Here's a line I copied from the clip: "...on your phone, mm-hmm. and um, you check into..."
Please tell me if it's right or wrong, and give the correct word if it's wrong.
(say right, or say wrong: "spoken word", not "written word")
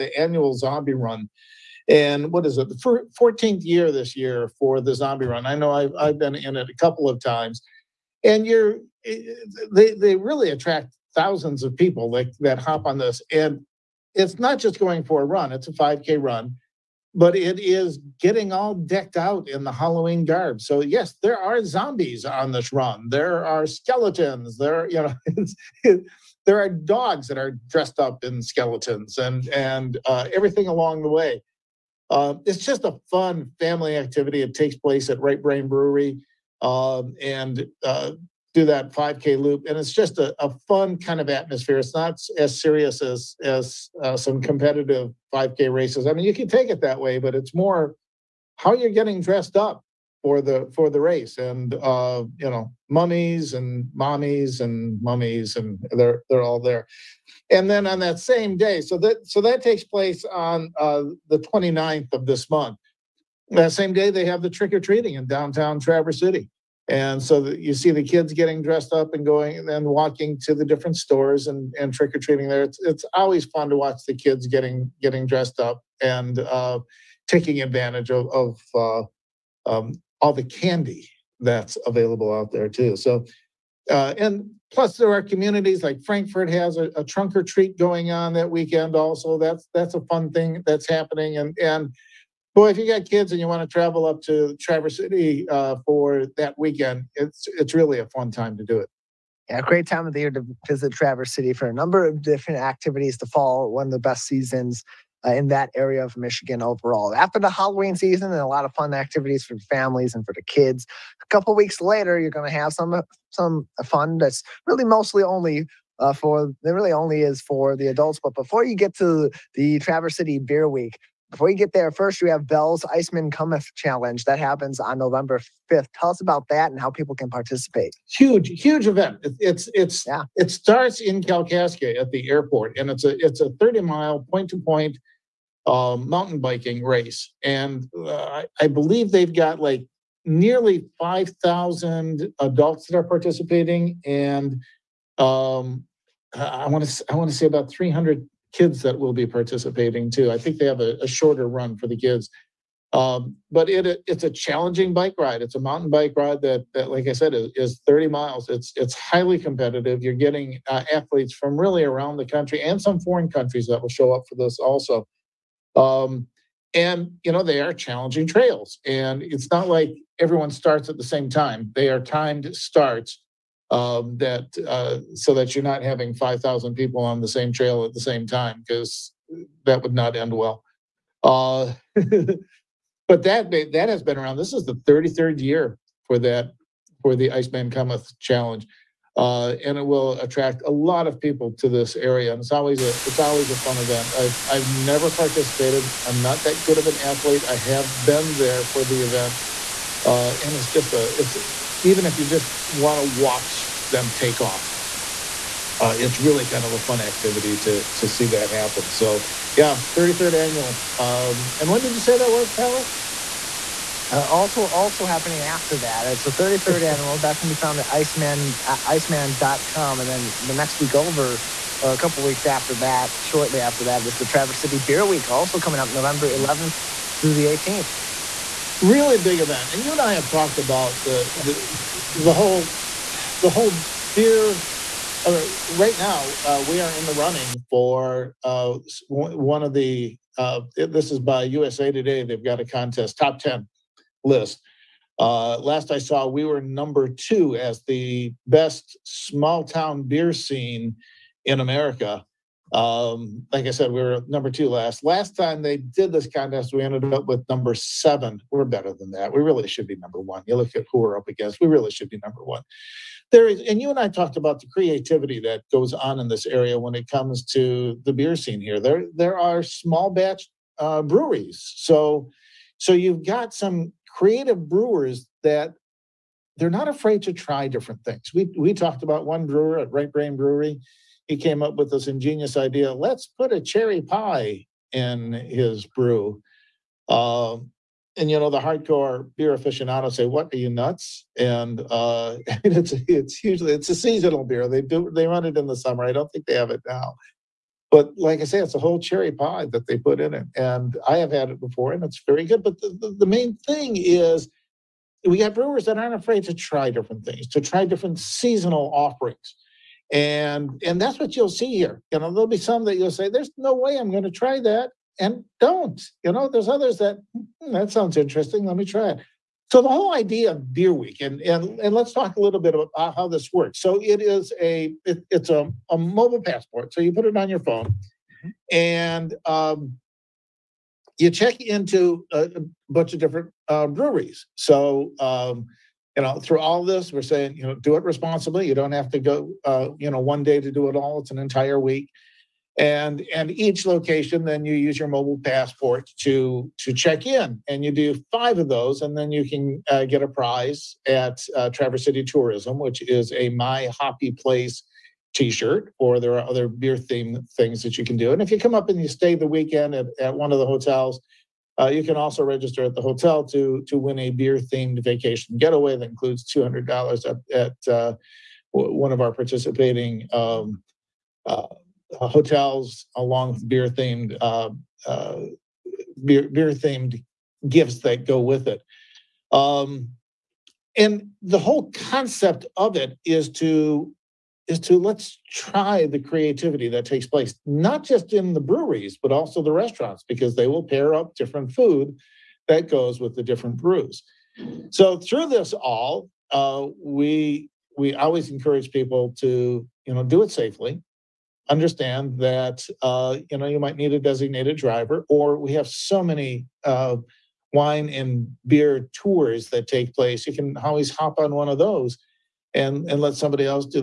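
right.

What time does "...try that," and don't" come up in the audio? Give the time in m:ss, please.
5:14.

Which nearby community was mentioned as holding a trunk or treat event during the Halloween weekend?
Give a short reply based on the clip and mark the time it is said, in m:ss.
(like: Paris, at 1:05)
Frankfort, at 1:26.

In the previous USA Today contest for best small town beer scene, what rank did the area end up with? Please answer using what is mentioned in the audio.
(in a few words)
7.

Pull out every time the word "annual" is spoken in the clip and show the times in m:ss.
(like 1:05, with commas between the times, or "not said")
0:00, 3:30, 3:36.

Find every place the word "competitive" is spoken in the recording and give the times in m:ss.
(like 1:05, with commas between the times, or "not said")
0:44, 2:39.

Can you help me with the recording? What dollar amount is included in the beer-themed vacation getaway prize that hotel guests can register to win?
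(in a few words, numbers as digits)
$200.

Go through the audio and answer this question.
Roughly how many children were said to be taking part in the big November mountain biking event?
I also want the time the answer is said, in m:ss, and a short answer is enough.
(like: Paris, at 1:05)
300, at 2:27.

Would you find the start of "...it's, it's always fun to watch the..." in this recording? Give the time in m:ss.
1:12.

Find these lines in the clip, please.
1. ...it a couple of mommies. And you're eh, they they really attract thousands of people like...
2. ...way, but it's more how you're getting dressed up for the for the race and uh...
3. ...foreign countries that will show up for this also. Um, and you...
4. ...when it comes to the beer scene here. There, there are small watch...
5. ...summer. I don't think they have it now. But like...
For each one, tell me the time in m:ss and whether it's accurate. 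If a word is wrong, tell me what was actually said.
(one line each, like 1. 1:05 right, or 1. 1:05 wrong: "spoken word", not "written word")
1. 0:06 wrong: "times", not "mommies"
2. 0:46 right
3. 2:42 right
4. 4:26 wrong: "batch", not "watch"
5. 4:55 right.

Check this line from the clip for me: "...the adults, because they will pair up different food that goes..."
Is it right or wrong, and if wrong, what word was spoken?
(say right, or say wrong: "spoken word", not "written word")
wrong: "restaurants", not "adults".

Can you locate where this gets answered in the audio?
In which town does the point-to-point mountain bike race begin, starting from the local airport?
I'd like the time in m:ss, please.
2:11.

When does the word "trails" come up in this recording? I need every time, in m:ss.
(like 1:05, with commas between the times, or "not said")
2:48, 2:57.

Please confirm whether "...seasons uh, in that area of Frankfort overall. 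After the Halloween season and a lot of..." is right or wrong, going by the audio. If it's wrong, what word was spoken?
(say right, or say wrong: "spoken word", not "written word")
wrong: "Michigan", not "Frankfort".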